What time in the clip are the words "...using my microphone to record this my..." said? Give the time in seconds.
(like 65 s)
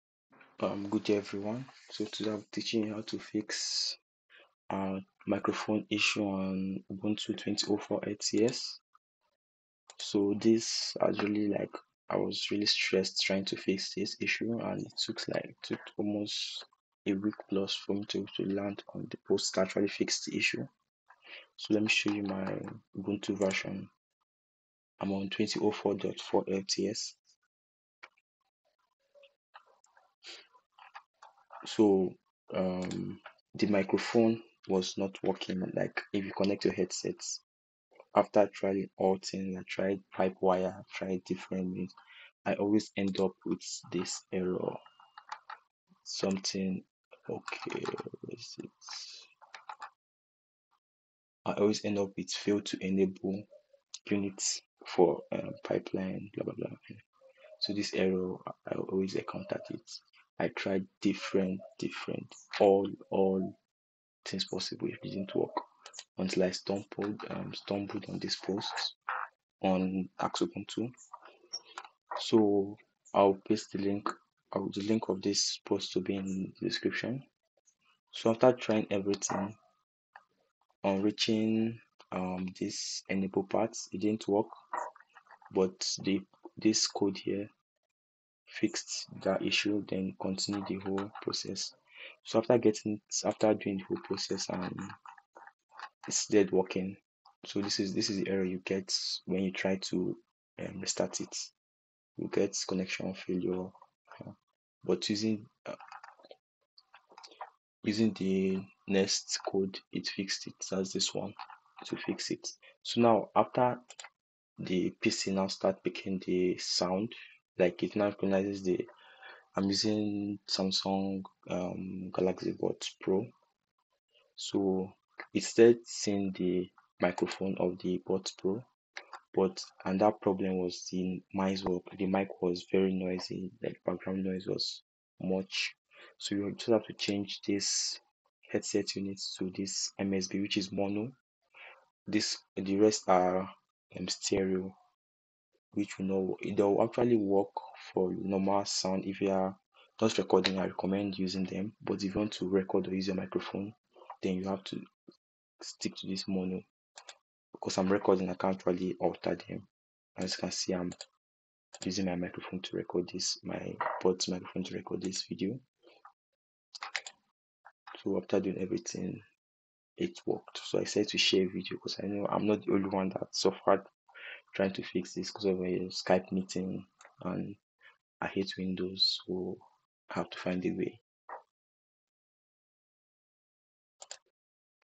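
161 s.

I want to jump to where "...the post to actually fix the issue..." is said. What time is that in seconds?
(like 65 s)
19 s.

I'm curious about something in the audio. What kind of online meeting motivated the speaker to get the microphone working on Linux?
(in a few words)
Skype meeting.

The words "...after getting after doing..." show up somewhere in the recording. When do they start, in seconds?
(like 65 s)
92 s.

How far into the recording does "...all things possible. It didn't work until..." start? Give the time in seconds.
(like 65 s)
63 s.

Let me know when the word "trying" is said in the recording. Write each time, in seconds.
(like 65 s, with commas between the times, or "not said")
13 s, 38 s, 78 s, 174 s.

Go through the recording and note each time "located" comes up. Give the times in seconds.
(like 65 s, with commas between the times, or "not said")
not said.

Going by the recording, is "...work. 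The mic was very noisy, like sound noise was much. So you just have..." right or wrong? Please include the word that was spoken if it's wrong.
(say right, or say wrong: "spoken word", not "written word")
wrong: "background", not "sound".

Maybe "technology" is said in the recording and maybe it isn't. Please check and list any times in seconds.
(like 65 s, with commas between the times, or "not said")
not said.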